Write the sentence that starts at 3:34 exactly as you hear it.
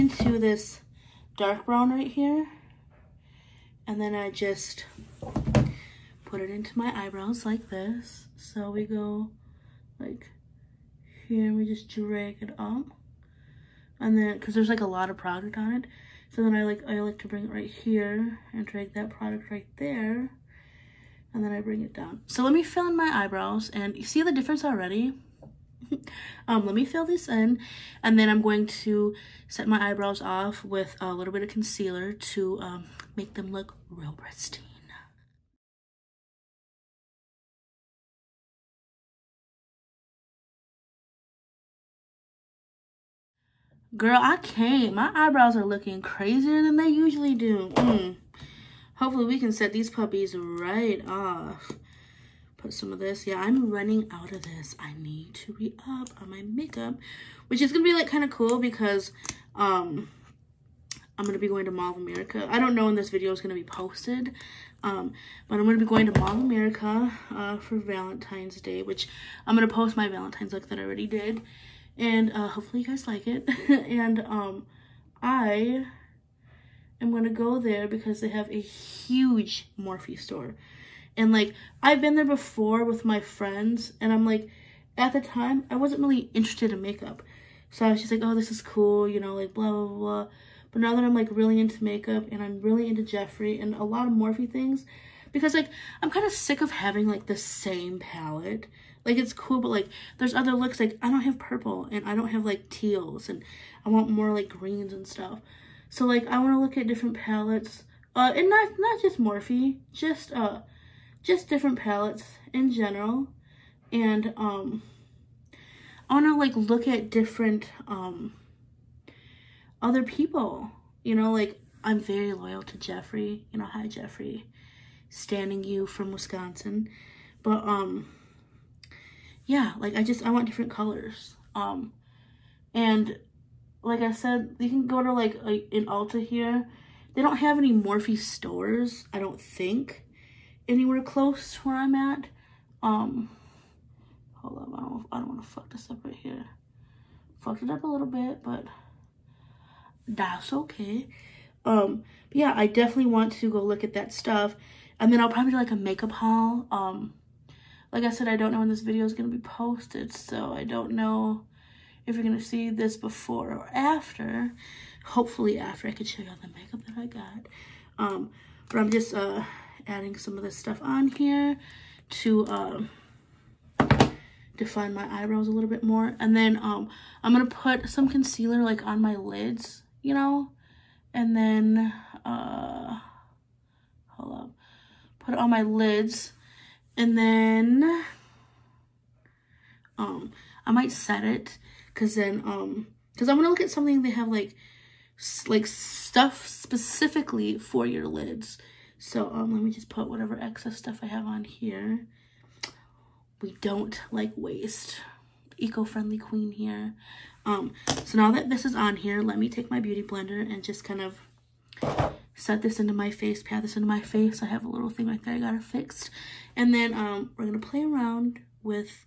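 I have a little thing right there.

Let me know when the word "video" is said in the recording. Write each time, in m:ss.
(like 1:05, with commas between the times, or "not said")
1:03, 2:38.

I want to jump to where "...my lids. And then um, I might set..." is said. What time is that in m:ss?
3:05.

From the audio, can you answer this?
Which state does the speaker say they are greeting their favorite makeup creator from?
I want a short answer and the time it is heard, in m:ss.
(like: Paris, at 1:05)
Wisconsin, at 2:06.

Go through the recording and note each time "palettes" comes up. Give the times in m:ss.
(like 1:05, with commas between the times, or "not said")
1:37, 1:47, 1:51.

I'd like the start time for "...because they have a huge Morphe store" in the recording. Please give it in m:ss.
1:17.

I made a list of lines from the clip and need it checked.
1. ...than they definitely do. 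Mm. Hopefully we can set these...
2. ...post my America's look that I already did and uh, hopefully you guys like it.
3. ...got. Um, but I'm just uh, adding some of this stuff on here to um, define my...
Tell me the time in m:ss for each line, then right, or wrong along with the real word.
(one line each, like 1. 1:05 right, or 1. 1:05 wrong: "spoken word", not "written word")
1. 0:46 wrong: "usually", not "definitely"
2. 1:09 wrong: "Valentine", not "America"
3. 2:47 right.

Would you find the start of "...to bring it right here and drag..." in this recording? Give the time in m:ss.
0:17.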